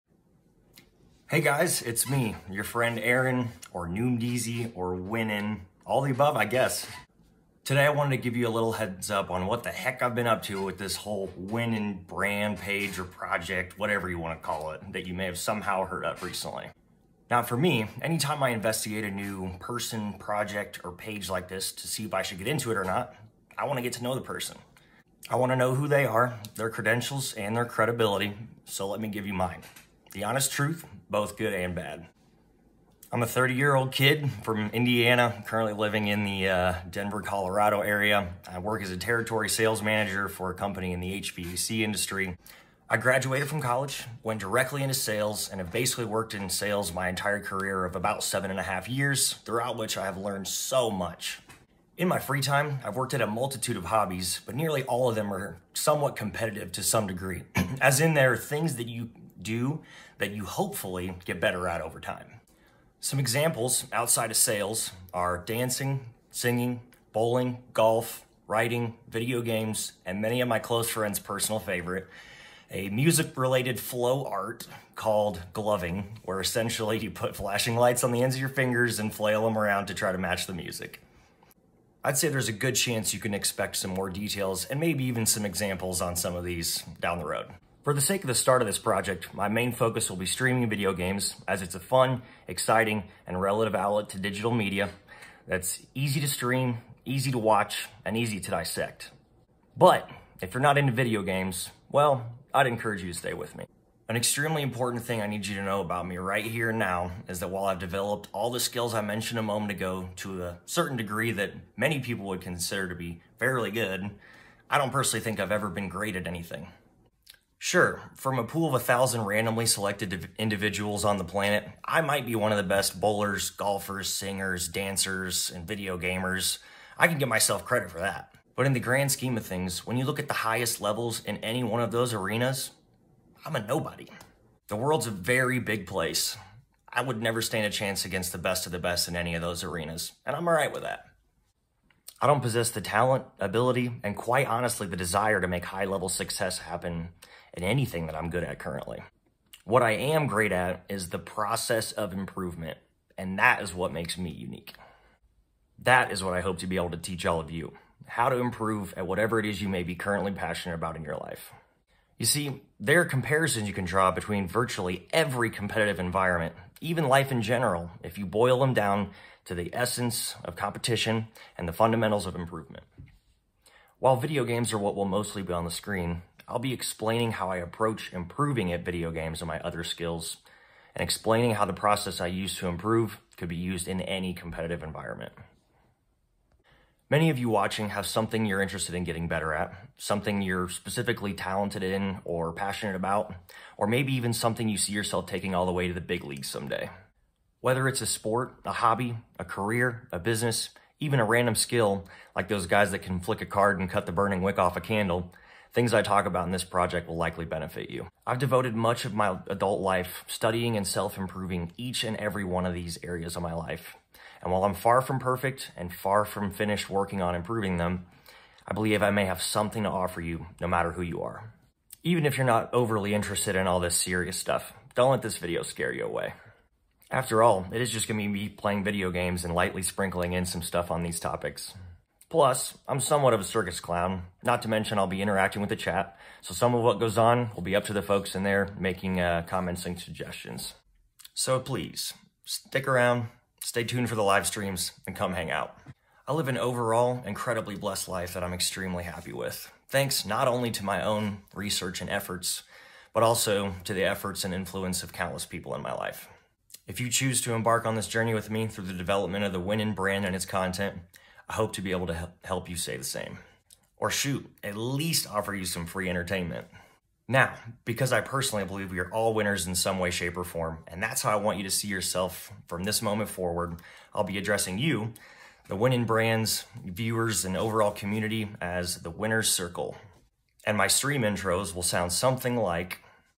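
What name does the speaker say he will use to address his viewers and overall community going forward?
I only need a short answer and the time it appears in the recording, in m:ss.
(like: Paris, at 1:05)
the winner's circle, at 4:38.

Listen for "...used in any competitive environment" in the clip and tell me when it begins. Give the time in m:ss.
3:03.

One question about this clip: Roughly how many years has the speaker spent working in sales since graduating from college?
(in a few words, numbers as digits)
7.5.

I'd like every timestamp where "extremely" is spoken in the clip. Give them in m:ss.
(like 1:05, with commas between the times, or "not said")
1:44, 4:08.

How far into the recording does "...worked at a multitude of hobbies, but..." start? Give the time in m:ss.
0:52.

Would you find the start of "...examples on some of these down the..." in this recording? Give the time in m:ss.
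1:25.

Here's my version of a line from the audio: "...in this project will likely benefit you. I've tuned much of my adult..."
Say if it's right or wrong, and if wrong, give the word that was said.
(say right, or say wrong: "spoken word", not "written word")
wrong: "devoted", not "tuned".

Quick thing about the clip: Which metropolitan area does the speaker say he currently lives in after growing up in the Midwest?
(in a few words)
Denver, Colorado.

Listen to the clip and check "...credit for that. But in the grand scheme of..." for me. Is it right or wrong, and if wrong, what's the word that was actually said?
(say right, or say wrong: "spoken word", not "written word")
right.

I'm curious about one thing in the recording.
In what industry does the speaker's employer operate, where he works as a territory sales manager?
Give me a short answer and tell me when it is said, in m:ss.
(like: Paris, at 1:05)
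HVAC, at 0:41.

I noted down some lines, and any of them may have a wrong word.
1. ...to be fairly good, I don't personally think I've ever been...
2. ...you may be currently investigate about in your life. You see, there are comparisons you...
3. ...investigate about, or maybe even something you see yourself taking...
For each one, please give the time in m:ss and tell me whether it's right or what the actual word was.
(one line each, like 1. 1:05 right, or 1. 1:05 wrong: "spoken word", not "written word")
1. 1:52 right
2. 2:39 wrong: "passionate", not "investigate"
3. 3:12 wrong: "passionate", not "investigate".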